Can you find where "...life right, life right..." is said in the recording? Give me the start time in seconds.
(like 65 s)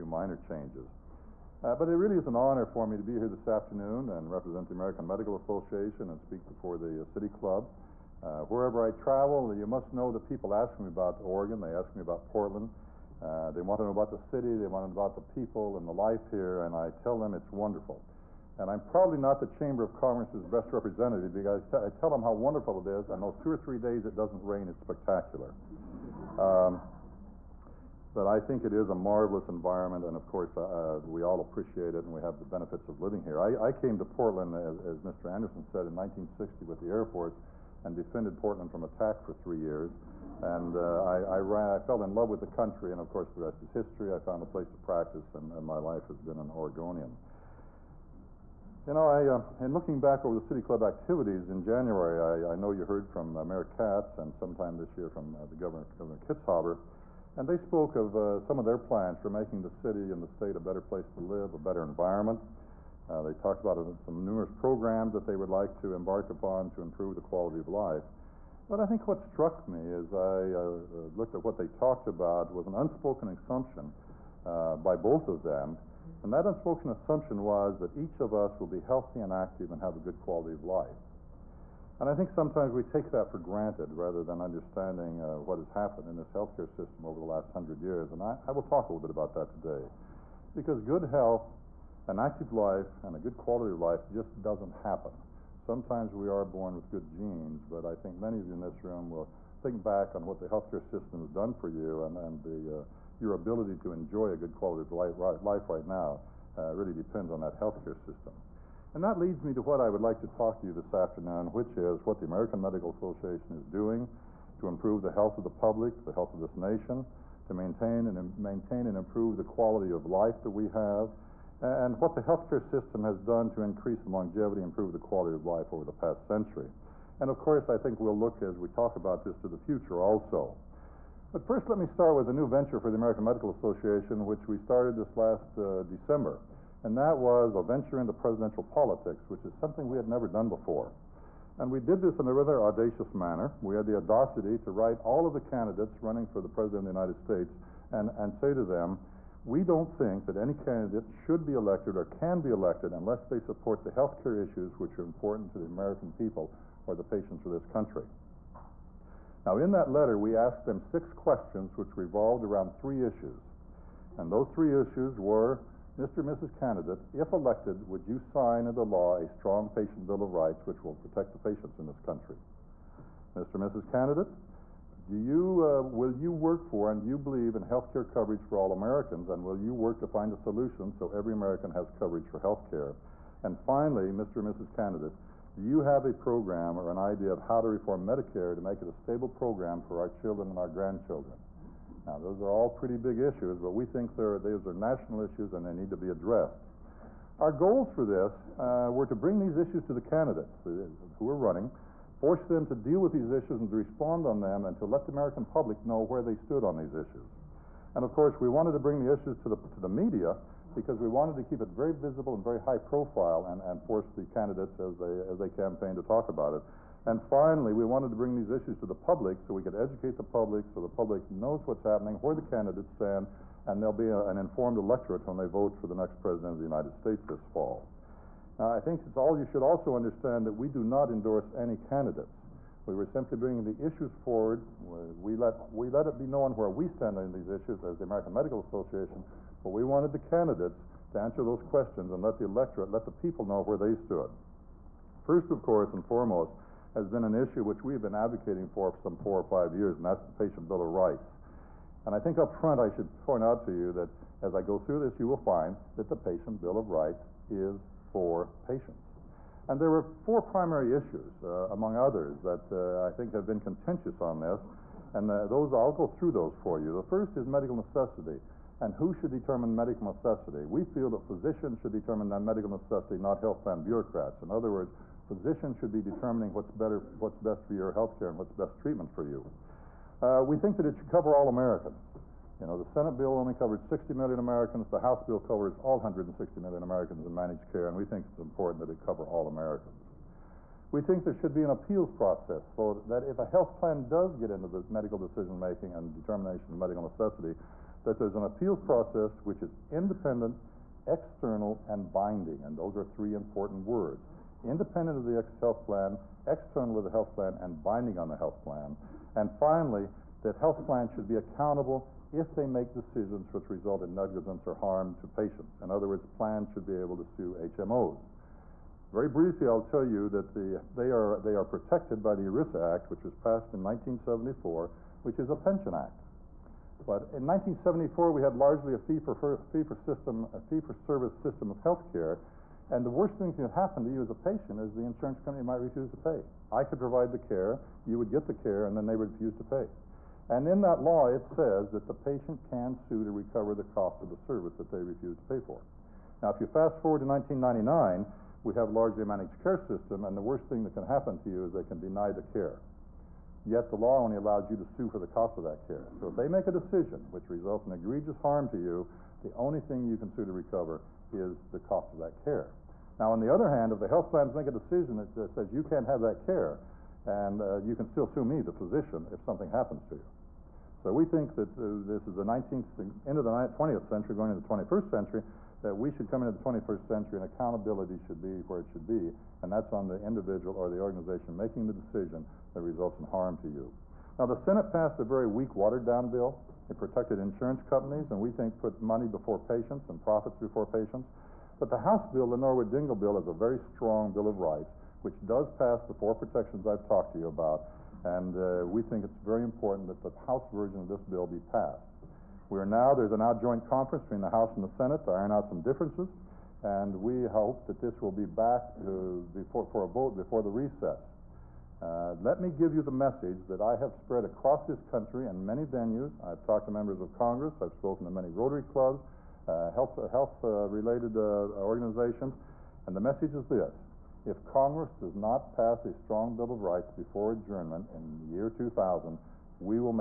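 104 s.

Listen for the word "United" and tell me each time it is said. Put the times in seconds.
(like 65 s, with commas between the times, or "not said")
147 s, 226 s.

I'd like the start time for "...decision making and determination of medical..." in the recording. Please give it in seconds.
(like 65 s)
295 s.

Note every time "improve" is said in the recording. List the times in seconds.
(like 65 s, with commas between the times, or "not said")
66 s, 114 s, 118 s, 124 s.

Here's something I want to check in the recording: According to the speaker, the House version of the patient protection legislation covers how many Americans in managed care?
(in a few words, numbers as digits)
160 million.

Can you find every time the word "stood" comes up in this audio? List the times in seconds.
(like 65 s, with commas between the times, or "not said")
206 s, 243 s.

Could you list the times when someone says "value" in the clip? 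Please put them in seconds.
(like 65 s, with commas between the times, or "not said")
not said.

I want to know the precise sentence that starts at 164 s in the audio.
And those three issues were Mr.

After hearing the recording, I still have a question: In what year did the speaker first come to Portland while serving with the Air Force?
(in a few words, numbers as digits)
1960.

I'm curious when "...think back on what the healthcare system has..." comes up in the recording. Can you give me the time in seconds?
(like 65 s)
99 s.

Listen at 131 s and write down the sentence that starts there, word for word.
But first, let me start with a new venture for the American Medical Association, which we started this last uh, December.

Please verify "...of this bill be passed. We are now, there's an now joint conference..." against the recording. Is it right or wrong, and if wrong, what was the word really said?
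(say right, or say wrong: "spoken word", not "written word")
right.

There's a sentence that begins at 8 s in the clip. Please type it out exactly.
wherever I travel, you must know that people ask me about Oregon, they ask me about Portland.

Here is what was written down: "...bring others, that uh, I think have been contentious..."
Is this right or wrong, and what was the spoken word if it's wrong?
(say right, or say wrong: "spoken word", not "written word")
wrong: "among", not "bring".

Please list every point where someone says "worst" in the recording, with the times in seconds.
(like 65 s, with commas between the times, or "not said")
333 s, 350 s.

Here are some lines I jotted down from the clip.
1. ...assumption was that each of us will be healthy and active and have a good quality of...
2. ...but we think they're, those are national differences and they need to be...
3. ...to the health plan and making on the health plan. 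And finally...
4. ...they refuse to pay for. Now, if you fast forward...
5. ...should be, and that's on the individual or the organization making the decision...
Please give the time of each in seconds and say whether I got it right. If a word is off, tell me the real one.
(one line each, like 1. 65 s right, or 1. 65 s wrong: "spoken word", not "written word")
1. 76 s right
2. 193 s wrong: "issues", not "differences"
3. 306 s wrong: "binding", not "making"
4. 344 s right
5. 378 s right.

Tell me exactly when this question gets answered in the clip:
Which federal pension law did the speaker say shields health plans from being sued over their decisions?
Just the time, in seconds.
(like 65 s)
322 s.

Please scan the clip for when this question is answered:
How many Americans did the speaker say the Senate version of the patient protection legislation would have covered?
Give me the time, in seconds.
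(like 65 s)
283 s.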